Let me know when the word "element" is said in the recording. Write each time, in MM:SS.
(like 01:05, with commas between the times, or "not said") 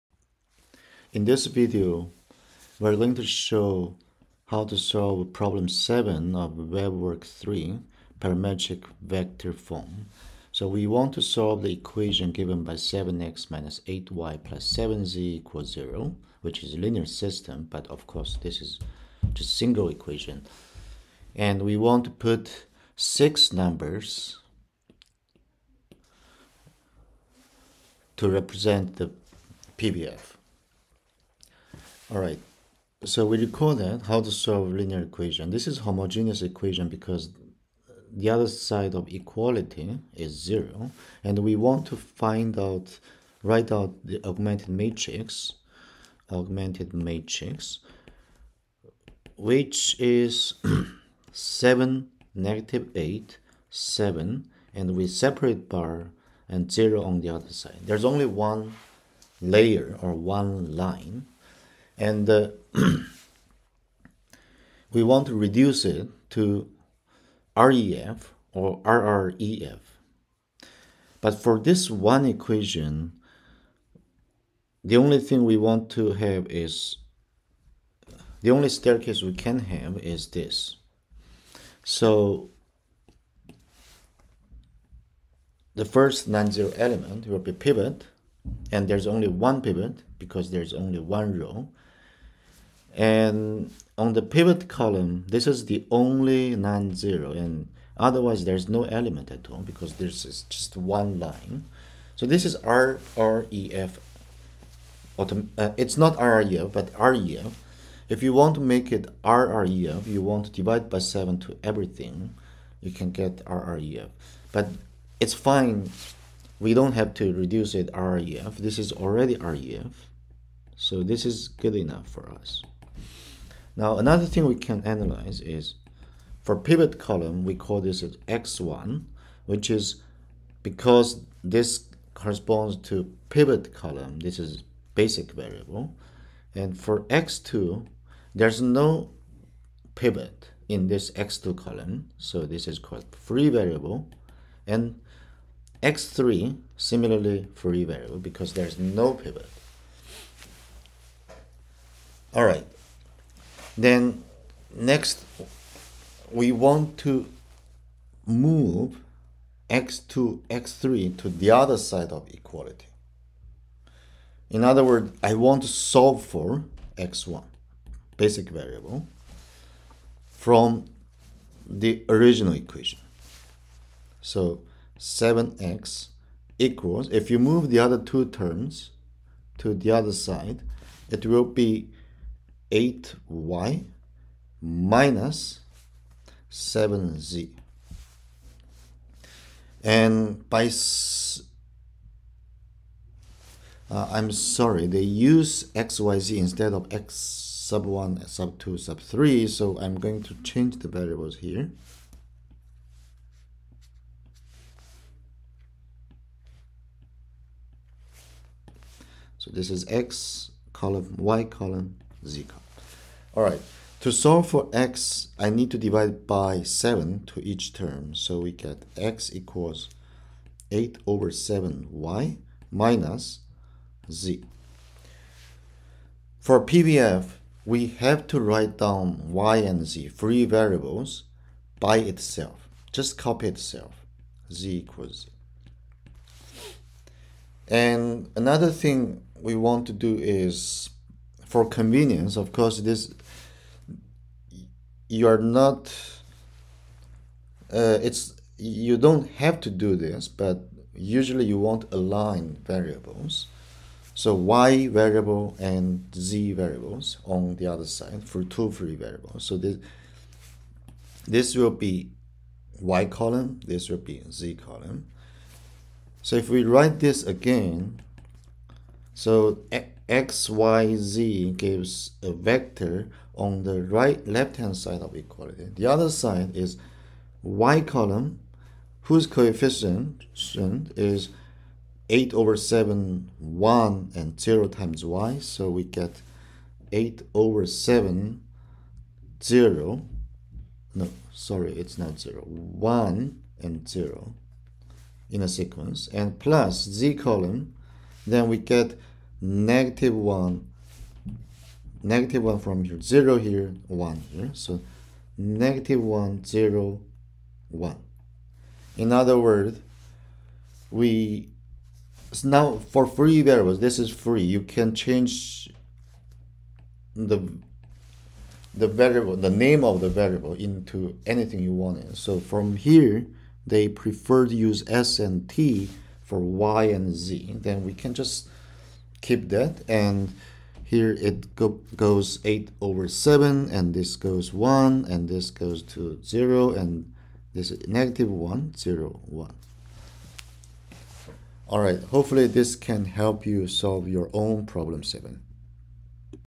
01:26, 01:38.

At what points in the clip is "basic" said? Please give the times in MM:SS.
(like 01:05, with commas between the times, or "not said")
02:14, 02:48.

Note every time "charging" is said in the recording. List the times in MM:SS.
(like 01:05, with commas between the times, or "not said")
not said.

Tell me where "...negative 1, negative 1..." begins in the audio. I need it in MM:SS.
04:59.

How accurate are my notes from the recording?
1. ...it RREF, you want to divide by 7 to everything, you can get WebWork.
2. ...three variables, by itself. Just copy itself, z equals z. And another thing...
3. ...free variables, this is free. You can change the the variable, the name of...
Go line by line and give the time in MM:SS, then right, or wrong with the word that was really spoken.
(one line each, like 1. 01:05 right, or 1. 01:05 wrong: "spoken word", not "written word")
1. 01:48 wrong: "RREF", not "WebWork"
2. 03:50 right
3. 05:13 right.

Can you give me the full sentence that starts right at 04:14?
So y variable and z variables on the other side for two free variables.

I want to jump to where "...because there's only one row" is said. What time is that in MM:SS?
01:30.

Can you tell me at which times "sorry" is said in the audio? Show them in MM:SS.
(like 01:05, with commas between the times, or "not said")
03:14, 04:51.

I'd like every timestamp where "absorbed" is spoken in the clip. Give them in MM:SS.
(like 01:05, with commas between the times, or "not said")
not said.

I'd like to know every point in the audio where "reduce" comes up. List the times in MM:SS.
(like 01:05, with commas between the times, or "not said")
01:05, 01:57.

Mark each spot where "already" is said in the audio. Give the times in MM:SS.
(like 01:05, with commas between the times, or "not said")
01:58.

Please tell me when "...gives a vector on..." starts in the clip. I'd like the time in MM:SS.
04:31.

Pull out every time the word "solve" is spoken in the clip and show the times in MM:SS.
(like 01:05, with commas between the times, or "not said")
00:04, 00:11, 00:34, 02:45, 03:34, 05:43.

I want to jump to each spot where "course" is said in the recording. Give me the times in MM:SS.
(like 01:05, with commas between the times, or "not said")
00:18, 04:02.